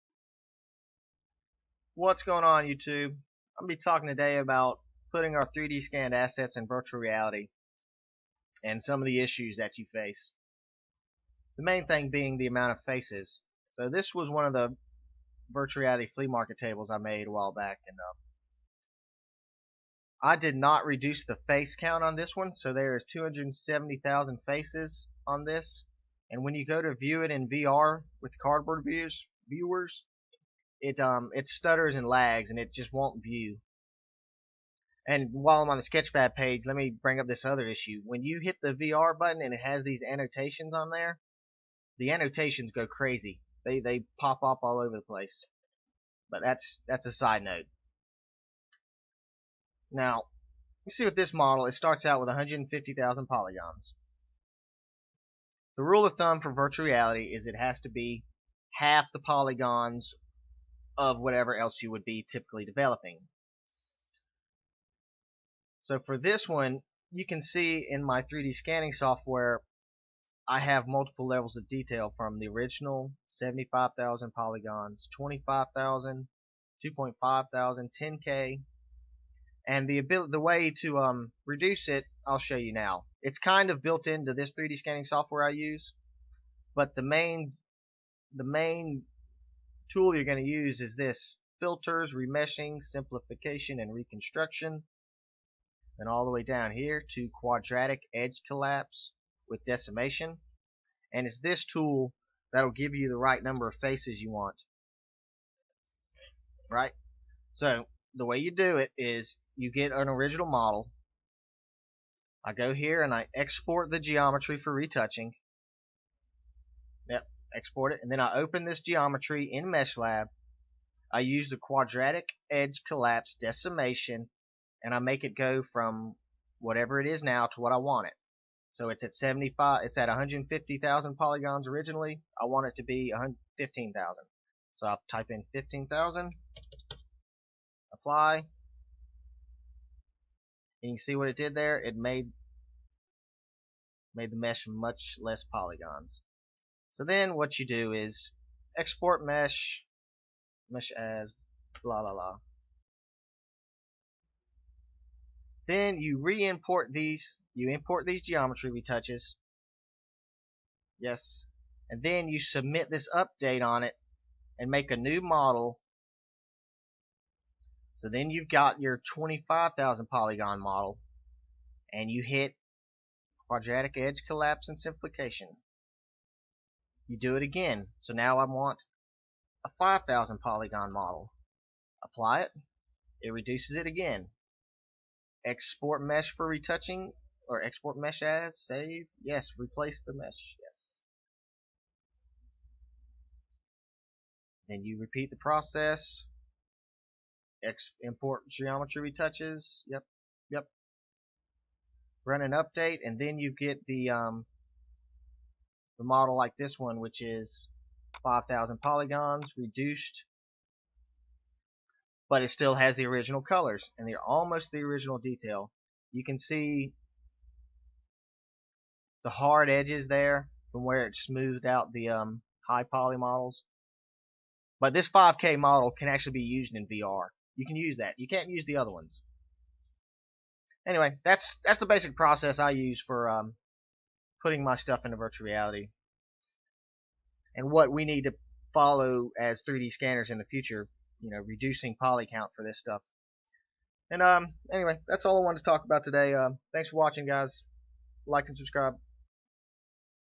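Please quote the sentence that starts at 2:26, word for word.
So then what you do is export mesh, mesh as blah blah blah.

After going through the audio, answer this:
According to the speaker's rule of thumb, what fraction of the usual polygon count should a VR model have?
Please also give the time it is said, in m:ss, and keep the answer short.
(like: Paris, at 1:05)
half, at 0:58.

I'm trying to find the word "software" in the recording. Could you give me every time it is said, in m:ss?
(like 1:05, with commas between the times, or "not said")
1:08, 1:25.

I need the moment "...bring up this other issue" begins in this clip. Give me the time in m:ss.
0:37.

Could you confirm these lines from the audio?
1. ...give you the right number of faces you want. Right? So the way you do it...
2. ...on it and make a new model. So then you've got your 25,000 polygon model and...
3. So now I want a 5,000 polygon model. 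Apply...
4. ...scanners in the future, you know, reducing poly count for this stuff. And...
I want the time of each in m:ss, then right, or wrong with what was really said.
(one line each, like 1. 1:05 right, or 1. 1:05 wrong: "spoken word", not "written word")
1. 1:42 right
2. 2:43 right
3. 2:57 right
4. 3:59 right.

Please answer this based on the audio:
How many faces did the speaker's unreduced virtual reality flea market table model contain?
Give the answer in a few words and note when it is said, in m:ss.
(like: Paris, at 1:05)
270,000, at 0:23.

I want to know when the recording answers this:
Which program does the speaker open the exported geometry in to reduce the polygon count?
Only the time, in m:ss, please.
1:59.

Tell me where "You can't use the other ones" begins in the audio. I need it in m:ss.
3:48.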